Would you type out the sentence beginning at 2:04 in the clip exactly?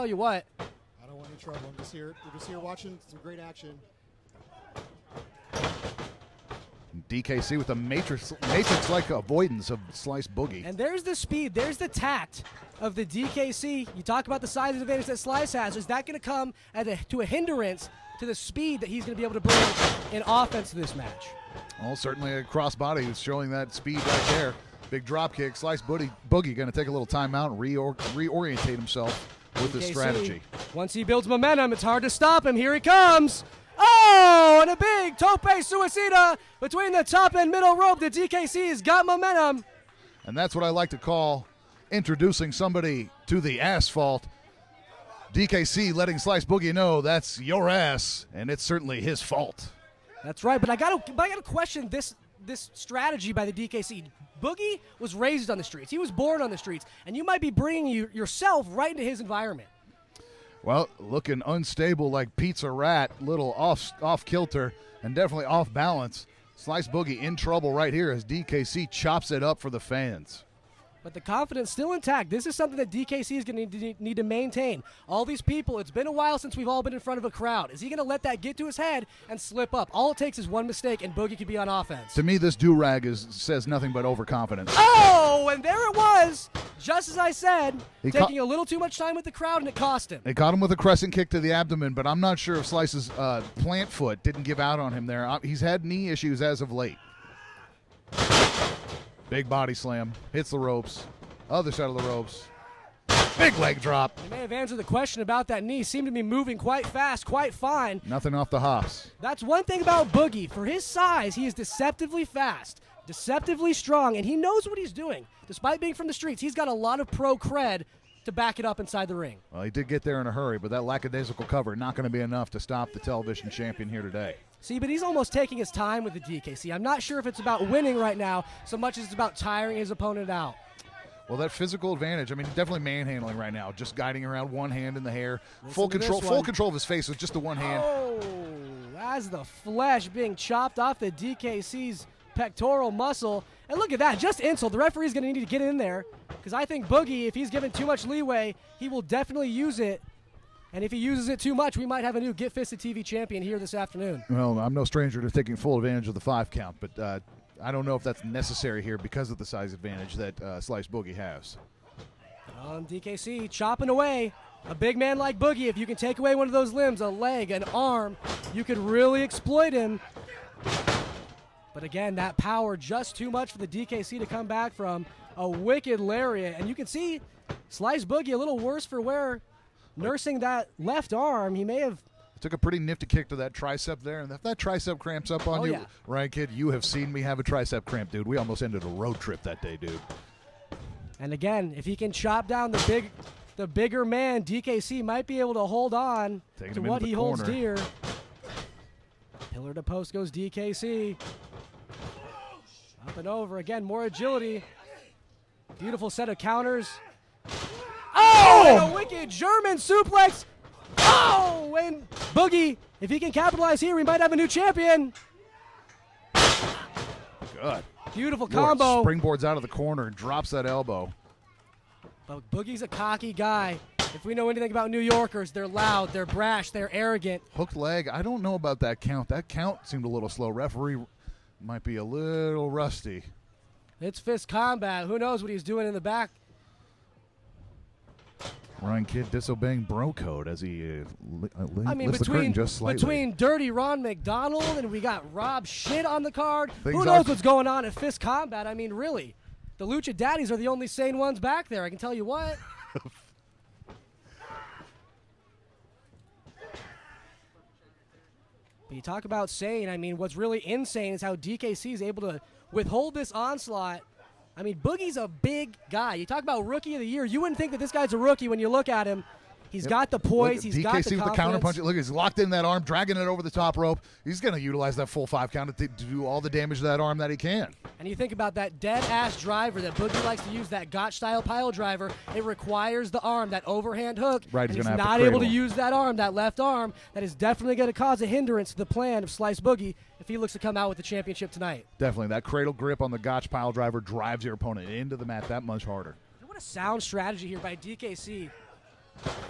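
See, but he's almost taking his time with the D.K.C.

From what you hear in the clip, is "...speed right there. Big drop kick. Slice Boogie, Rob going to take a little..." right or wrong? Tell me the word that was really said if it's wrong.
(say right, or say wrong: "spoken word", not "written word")
wrong: "Boogie", not "Rob".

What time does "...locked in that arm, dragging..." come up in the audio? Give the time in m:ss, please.
4:32.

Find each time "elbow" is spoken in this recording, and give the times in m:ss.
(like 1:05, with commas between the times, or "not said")
3:40.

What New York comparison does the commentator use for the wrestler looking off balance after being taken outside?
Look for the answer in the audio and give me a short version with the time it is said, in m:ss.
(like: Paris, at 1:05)
Pizza Rat, at 1:02.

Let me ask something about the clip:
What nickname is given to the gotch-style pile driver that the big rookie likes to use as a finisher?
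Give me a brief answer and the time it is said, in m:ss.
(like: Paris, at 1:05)
dead ass driver, at 4:38.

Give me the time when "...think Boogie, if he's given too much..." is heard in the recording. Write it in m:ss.
2:26.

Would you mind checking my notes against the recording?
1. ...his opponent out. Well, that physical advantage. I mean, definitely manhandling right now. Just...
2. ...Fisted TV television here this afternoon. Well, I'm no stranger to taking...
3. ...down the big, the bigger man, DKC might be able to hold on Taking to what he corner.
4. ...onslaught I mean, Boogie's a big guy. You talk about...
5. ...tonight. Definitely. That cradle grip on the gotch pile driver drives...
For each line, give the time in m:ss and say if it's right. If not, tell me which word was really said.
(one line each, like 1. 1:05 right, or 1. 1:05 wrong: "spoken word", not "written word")
1. 2:09 right
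2. 2:32 wrong: "champion", not "television"
3. 3:12 right
4. 4:23 right
5. 4:51 right.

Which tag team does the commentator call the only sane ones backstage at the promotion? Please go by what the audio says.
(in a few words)
Lucha Daddies.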